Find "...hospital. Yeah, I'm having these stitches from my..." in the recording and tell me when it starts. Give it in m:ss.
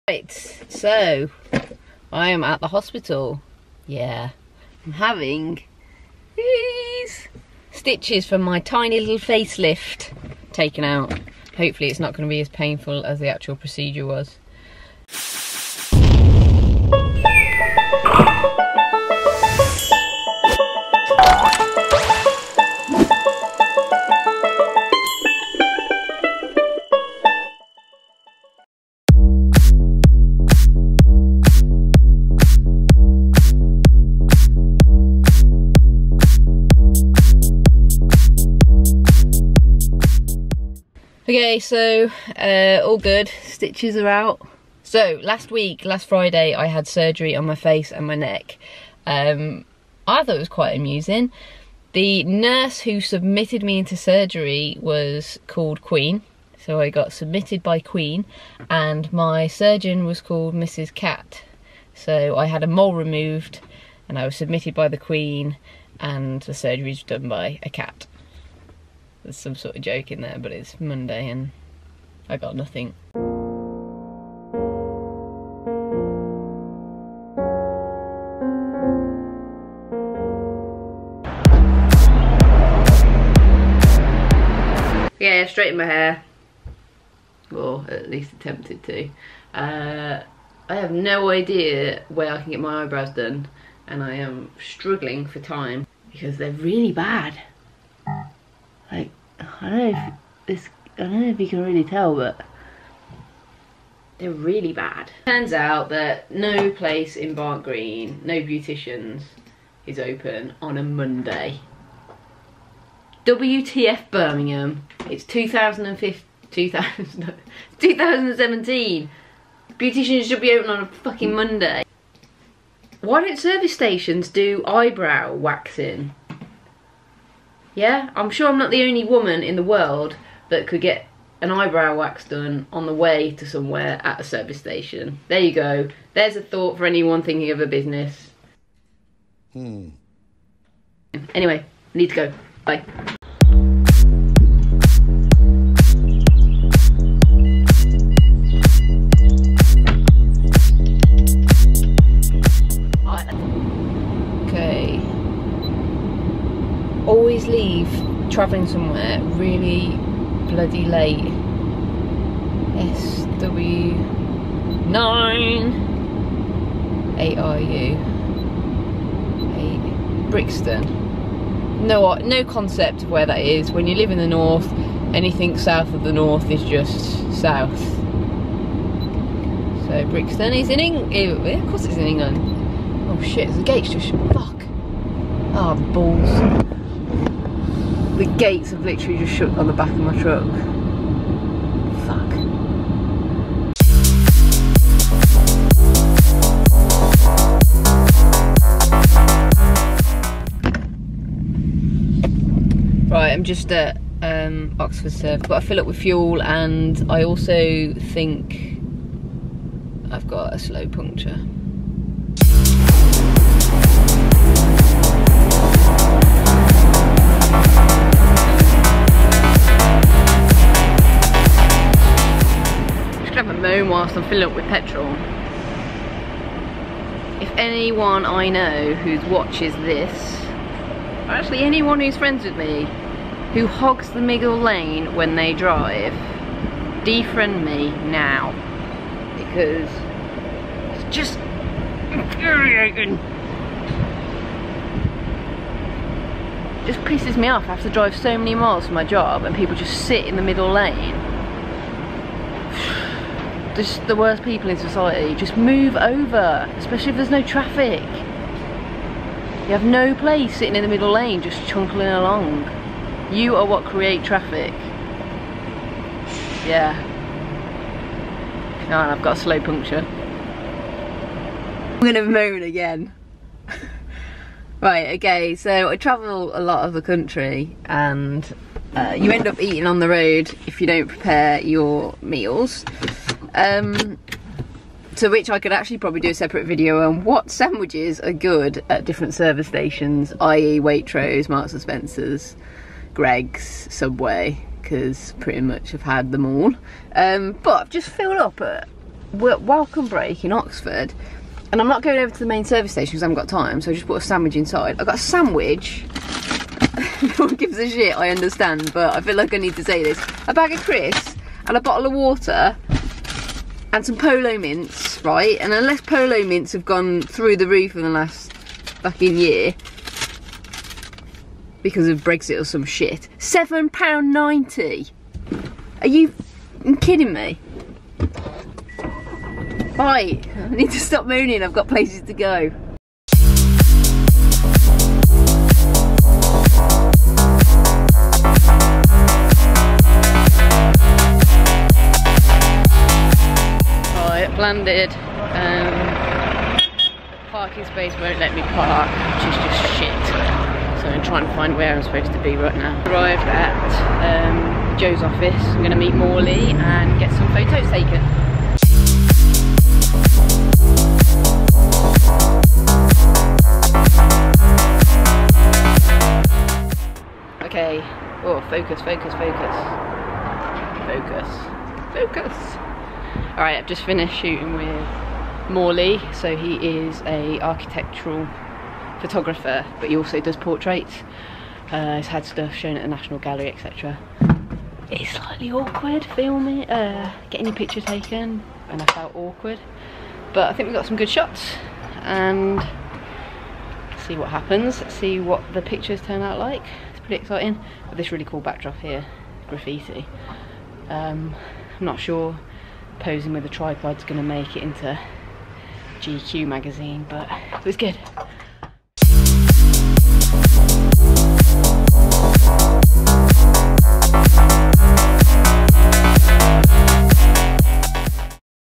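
0:02.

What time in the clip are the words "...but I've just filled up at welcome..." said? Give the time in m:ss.
4:57.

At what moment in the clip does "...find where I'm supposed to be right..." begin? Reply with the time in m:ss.
5:51.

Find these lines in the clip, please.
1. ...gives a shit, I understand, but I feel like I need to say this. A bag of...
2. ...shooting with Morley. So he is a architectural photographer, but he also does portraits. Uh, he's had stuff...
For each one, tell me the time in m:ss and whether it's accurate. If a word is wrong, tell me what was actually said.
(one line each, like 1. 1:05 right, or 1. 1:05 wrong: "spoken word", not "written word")
1. 5:07 right
2. 6:14 right.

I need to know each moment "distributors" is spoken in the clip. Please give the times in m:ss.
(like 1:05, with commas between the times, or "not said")
not said.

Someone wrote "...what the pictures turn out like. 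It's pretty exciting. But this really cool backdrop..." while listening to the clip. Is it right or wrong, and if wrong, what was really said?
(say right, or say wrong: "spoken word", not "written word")
right.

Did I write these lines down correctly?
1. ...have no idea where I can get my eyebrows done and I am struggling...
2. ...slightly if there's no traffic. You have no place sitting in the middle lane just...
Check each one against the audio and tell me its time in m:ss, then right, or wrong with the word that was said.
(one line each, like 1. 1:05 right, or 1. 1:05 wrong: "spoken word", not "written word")
1. 1:30 right
2. 4:16 wrong: "especially", not "slightly".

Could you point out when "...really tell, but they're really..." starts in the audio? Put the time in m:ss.
1:41.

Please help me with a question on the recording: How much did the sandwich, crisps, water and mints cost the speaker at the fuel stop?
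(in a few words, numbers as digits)
£7.90.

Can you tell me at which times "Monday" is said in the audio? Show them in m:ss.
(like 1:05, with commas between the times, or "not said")
1:10, 1:50, 2:01.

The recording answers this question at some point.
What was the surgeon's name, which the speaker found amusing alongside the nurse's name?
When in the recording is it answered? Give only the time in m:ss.
1:00.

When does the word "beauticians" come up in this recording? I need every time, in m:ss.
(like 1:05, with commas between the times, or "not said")
1:48, 1:59.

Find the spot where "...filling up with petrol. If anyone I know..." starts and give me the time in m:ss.
3:44.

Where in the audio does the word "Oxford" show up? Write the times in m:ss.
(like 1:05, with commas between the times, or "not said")
3:24, 5:00.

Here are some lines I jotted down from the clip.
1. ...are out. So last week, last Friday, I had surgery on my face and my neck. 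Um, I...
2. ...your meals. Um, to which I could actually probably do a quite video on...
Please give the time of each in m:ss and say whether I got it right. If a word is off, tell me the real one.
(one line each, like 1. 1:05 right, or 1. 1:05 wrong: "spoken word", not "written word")
1. 0:43 right
2. 4:41 wrong: "separate", not "quite".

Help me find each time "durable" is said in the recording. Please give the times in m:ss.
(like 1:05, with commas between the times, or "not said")
not said.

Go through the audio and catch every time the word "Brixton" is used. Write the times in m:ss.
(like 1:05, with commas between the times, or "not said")
2:50, 3:00.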